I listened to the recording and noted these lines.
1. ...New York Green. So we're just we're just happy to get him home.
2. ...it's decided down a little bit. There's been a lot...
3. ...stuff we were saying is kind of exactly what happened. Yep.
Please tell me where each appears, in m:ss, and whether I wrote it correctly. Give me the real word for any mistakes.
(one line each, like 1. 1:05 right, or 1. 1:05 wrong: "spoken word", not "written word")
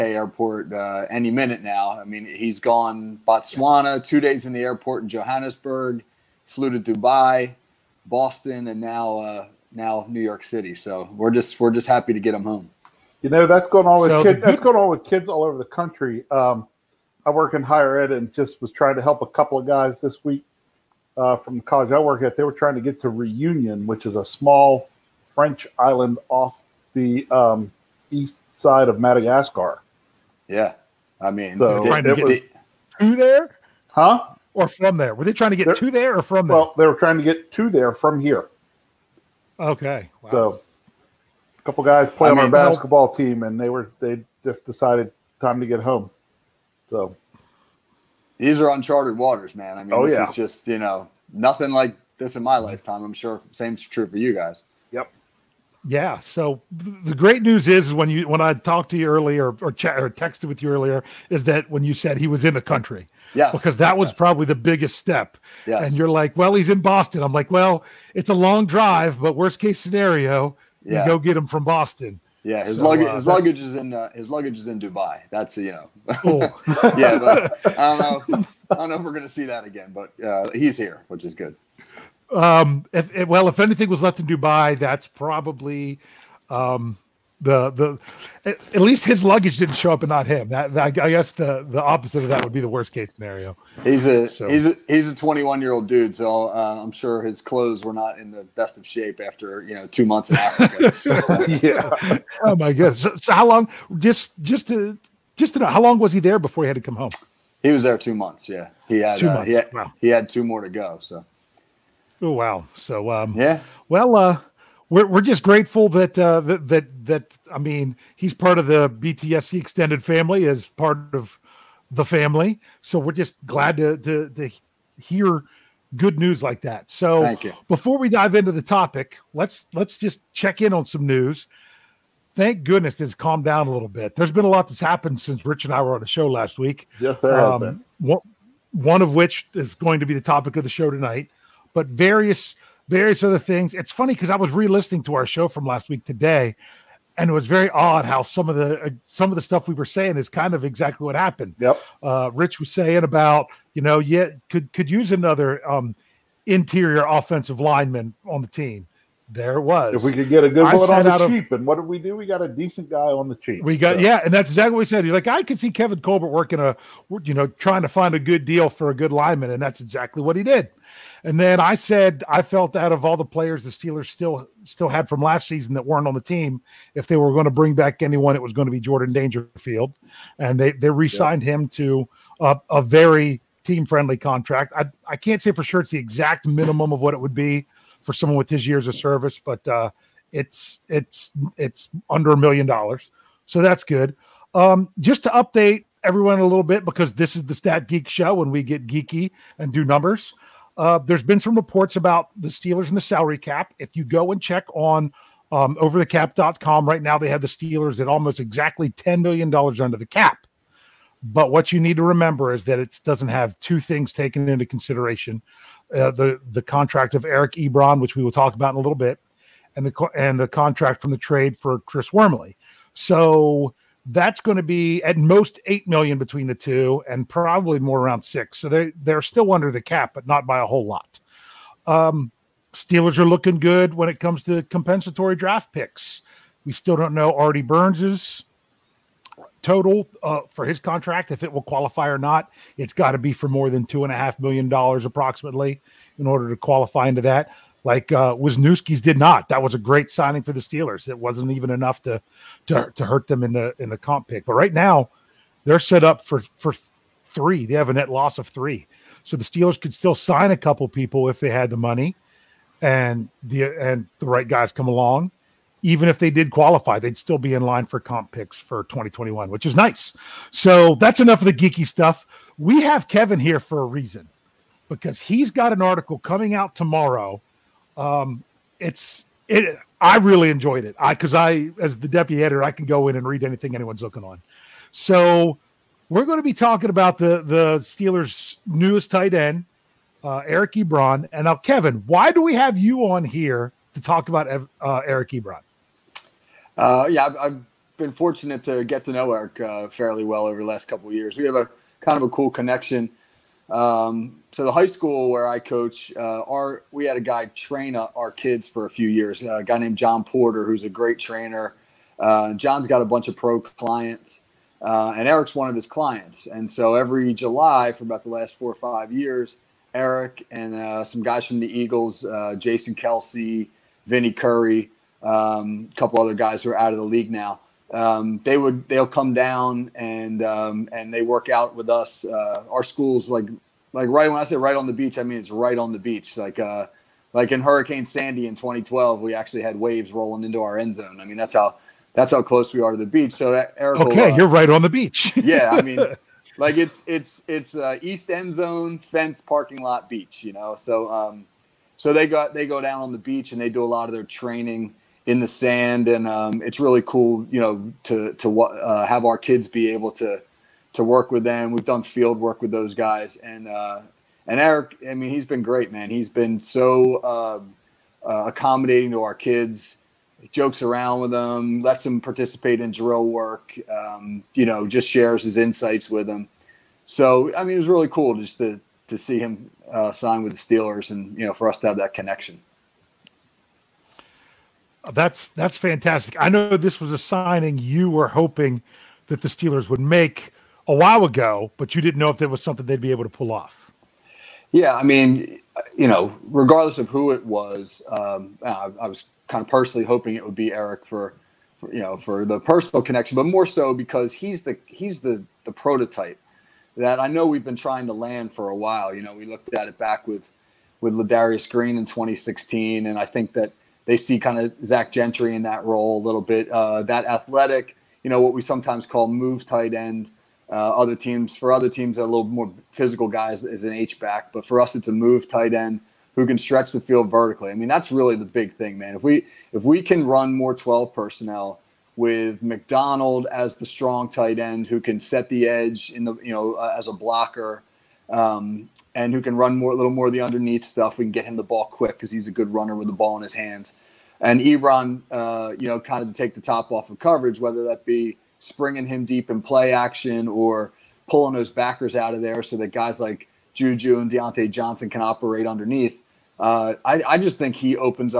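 1. 0:10 wrong: "City", not "Green"
2. 2:13 wrong: "calmed", not "decided"
3. 2:29 right.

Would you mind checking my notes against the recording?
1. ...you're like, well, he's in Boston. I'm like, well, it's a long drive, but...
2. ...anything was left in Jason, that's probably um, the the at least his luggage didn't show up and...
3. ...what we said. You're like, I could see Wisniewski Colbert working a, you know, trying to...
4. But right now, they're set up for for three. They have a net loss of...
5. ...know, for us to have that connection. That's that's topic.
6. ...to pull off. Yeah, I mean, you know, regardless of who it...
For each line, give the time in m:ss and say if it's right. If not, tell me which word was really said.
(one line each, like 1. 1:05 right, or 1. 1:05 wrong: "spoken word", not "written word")
1. 1:05 right
2. 1:23 wrong: "Dubai", not "Jason"
3. 2:44 wrong: "Kevin", not "Wisniewski"
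4. 4:14 right
5. 6:21 wrong: "fantastic", not "topic"
6. 6:33 right.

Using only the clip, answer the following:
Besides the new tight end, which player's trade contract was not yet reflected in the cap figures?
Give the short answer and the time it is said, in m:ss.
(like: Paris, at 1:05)
Chris Wormley, at 3:41.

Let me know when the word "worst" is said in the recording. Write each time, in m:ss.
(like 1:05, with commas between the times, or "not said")
1:09, 1:32.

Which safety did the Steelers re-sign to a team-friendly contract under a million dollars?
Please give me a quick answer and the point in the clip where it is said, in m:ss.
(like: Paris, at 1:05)
Jordan Dangerfield, at 2:58.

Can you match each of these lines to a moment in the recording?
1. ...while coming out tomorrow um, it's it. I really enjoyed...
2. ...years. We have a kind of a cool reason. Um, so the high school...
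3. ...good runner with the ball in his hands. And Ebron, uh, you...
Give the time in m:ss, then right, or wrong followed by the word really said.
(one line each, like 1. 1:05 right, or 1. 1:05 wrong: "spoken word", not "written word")
1. 4:35 wrong: "article", not "while"
2. 5:01 wrong: "connection", not "reason"
3. 7:22 right.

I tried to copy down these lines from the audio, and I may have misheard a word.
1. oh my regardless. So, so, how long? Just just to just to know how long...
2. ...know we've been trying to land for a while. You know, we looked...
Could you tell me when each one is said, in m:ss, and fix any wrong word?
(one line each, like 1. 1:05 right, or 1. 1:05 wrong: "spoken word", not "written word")
1. 1:42 wrong: "goodness", not "regardless"
2. 6:47 right.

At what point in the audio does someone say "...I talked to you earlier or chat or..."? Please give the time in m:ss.
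0:58.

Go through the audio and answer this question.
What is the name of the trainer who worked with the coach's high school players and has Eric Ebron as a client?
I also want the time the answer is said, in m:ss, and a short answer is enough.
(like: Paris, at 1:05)
John Porter, at 5:09.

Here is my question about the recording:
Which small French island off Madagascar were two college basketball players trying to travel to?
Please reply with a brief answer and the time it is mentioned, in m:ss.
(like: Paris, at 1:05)
Reunion, at 0:23.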